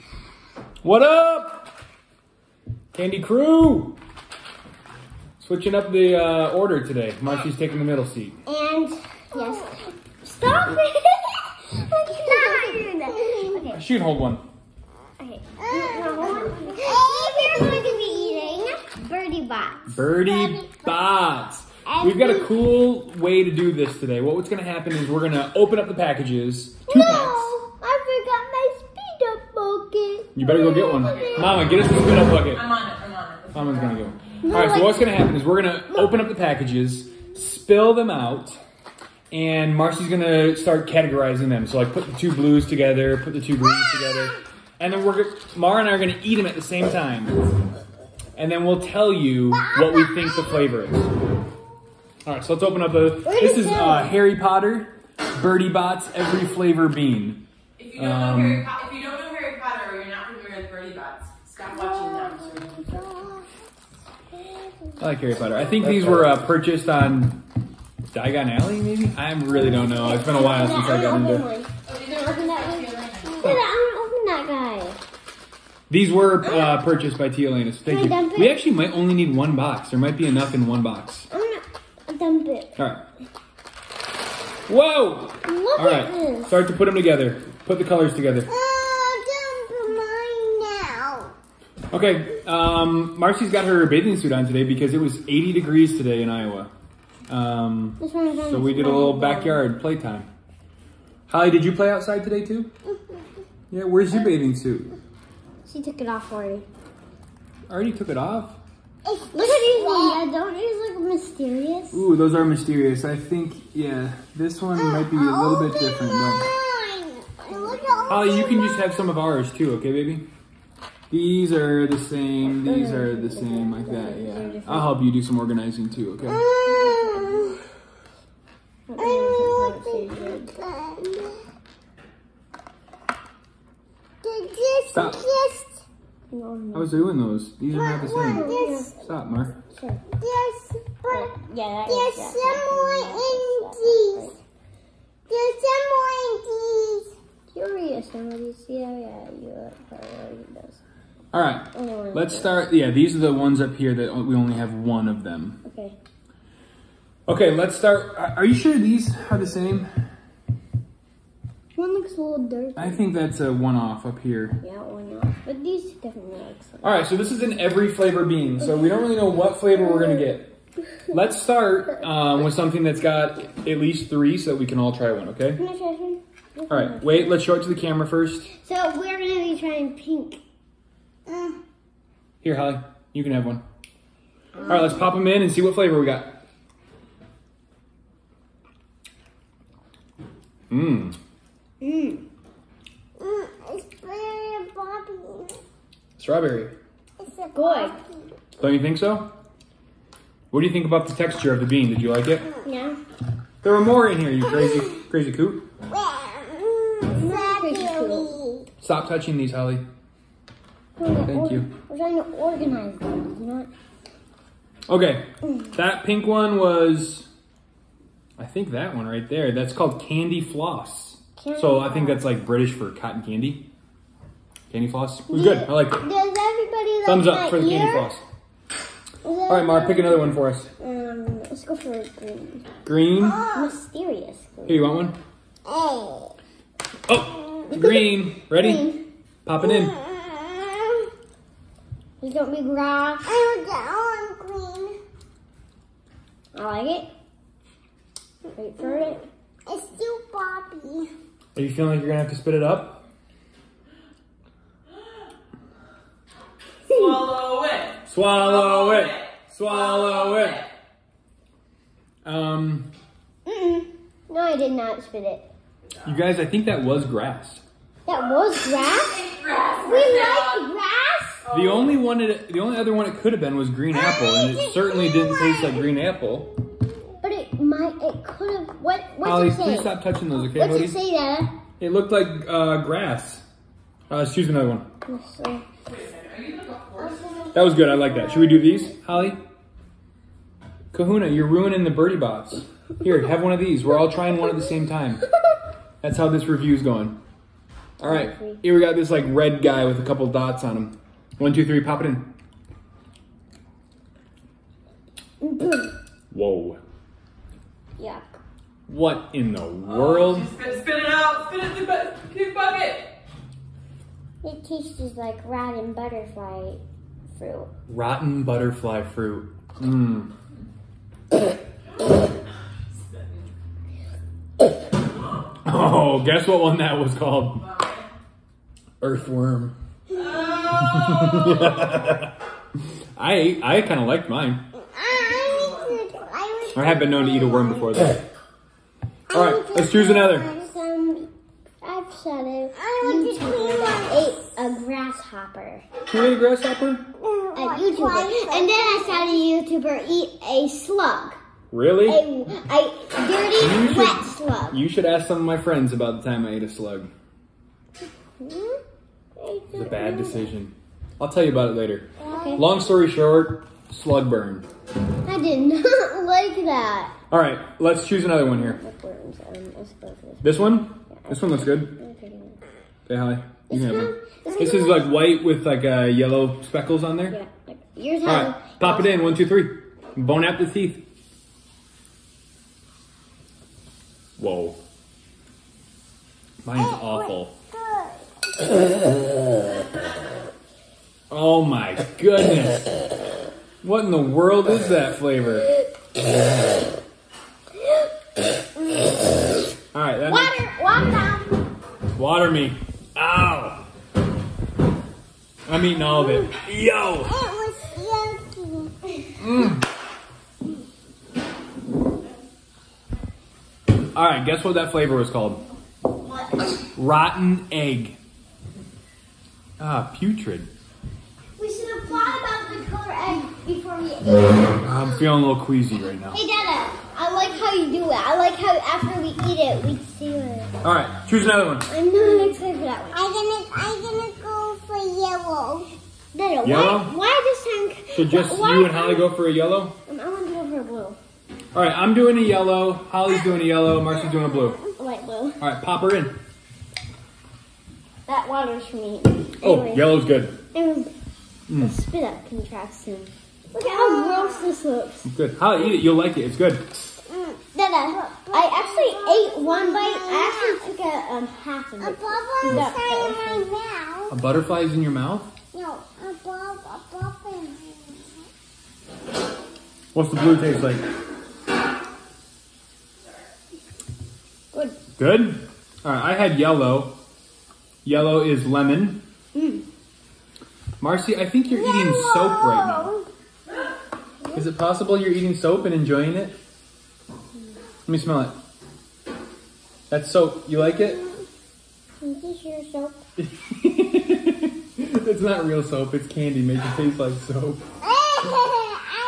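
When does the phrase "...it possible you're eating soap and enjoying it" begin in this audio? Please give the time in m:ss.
8:04.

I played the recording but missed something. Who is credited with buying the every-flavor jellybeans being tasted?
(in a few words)
Tia.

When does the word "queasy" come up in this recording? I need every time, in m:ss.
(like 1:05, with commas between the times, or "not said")
7:05.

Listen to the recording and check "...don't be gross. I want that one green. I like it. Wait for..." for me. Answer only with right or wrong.
right.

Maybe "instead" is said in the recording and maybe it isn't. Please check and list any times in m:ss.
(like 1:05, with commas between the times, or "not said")
not said.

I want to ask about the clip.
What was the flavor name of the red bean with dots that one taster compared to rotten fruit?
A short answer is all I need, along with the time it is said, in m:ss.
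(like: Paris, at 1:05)
Earthworm, at 5:29.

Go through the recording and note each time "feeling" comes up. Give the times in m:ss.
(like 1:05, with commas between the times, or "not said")
4:11, 7:05.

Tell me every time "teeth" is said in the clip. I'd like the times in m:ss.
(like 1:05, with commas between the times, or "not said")
6:20.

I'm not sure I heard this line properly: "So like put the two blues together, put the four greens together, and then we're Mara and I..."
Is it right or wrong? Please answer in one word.
wrong.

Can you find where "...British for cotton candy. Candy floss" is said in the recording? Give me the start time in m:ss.
3:42.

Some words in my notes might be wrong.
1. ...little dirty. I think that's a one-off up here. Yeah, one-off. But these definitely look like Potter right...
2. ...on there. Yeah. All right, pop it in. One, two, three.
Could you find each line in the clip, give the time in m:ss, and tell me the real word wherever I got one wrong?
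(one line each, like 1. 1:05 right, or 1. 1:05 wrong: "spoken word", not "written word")
1. 2:42 wrong: "All", not "Potter"
2. 6:17 right.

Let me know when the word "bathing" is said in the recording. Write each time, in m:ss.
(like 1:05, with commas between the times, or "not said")
1:33, 1:44.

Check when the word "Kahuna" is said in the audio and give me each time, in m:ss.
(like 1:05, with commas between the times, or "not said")
4:50.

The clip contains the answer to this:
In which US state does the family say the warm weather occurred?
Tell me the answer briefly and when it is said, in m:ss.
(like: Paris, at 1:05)
Iowa, at 1:36.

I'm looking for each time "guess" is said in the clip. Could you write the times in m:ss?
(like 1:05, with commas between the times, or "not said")
5:26, 6:54.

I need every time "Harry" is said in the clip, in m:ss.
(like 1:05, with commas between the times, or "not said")
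0:54, 1:05.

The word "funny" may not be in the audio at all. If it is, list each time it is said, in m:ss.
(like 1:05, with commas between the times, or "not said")
not said.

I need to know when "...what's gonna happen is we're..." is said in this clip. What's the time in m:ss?
0:34.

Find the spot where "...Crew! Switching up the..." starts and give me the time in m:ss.
0:03.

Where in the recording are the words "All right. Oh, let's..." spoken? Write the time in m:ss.
2:31.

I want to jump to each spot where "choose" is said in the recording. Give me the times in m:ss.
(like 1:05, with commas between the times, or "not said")
4:44, 5:39, 6:08, 7:11.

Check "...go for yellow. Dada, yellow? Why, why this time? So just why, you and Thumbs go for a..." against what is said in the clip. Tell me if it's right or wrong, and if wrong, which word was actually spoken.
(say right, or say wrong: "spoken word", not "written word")
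wrong: "Holly", not "Thumbs".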